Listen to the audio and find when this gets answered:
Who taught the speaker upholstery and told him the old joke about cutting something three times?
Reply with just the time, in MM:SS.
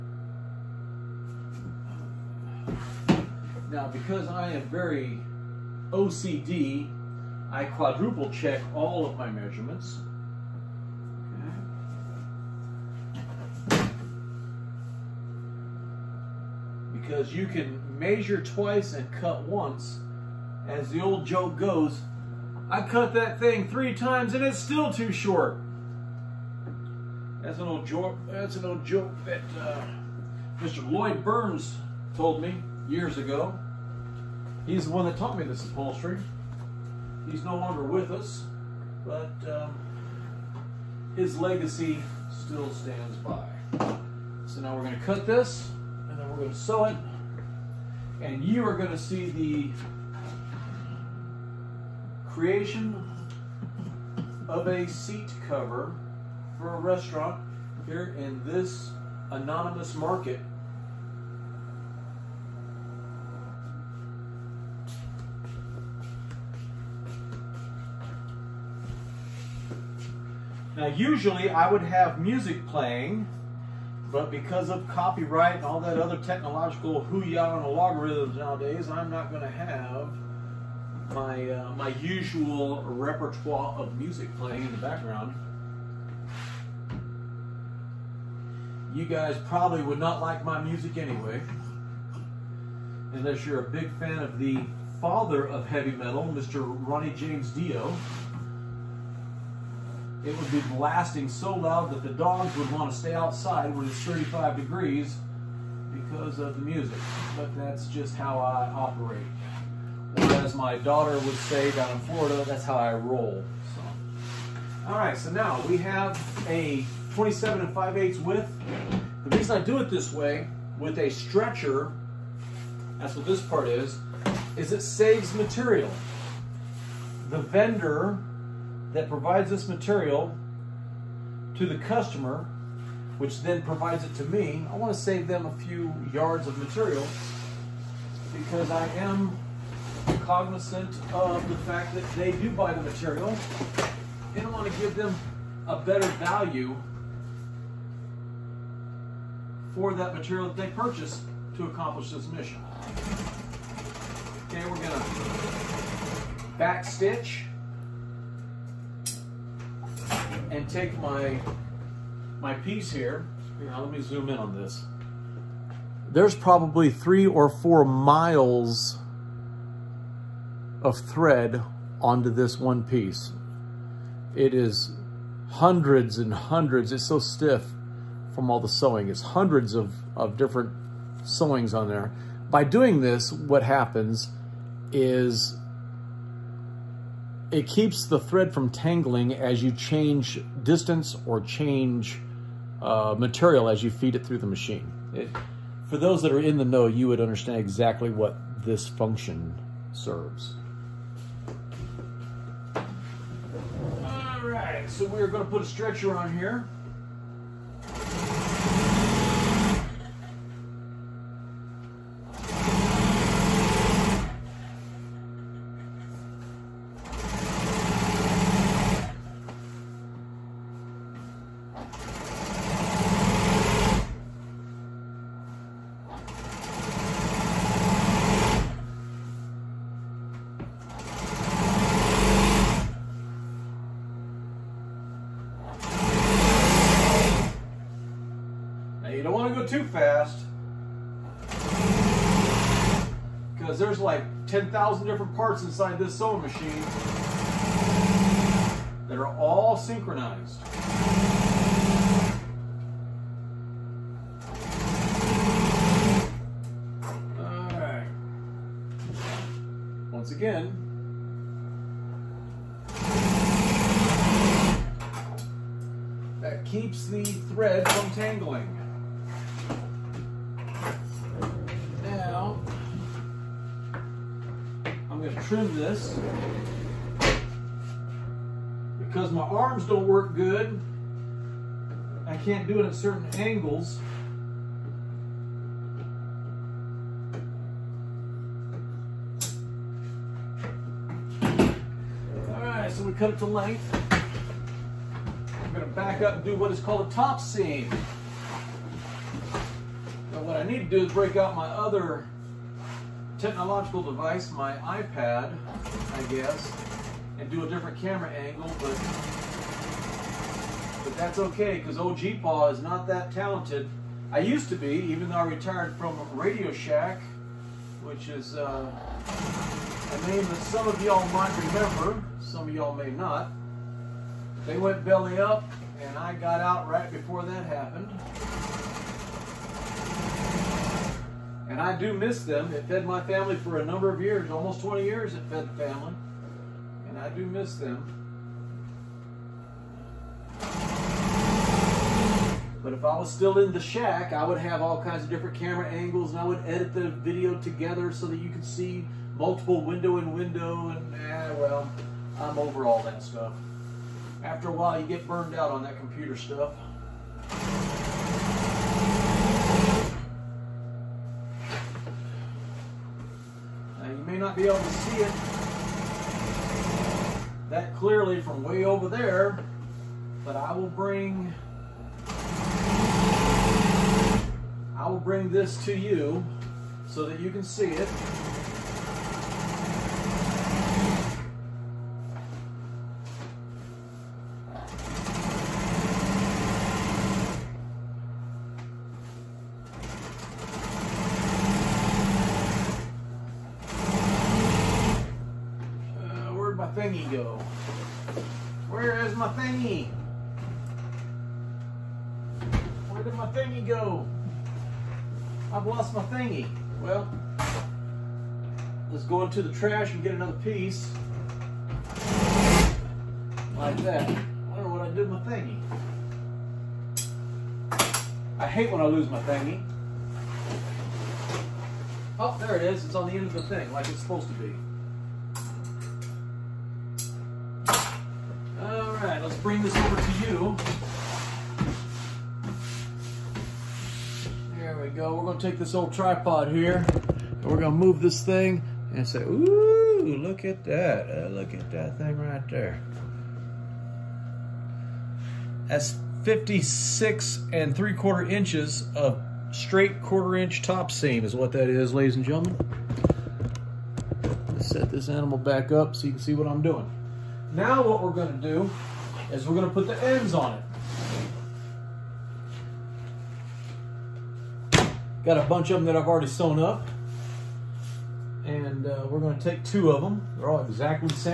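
00:30.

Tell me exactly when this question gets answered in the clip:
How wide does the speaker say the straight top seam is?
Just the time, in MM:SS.
07:30.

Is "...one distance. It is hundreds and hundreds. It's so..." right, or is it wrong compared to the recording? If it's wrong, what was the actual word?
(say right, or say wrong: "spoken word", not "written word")
wrong: "piece", not "distance".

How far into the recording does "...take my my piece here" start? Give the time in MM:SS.
02:40.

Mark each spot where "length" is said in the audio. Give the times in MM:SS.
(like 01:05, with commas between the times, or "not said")
04:53.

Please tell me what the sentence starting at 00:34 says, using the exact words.
He's the one that taught me this upholstery.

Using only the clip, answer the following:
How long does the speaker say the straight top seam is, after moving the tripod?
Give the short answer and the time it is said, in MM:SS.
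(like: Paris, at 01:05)
56 3/4 inches, at 07:26.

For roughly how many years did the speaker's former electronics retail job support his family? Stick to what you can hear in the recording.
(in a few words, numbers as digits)
almost 20 years.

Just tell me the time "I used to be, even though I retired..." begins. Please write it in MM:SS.
05:14.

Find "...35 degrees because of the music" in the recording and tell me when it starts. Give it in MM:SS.
01:44.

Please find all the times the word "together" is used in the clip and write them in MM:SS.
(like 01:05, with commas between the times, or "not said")
05:47.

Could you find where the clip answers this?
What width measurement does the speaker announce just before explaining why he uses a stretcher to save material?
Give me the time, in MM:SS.
01:57.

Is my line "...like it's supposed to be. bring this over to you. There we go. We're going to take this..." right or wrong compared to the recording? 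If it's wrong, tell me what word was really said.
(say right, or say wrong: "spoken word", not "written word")
right.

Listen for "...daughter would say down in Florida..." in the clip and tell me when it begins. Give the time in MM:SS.
01:50.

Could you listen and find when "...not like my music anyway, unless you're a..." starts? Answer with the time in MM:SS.
01:29.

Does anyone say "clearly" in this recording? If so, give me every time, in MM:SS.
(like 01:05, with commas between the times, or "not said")
06:07.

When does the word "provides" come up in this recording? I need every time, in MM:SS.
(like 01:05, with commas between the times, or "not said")
02:09, 02:13.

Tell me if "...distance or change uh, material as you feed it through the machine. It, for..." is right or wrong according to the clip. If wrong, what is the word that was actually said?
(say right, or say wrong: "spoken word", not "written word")
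right.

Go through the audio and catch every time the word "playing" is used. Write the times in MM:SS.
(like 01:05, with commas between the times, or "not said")
01:12, 01:24.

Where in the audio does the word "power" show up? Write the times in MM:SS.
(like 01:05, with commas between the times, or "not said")
not said.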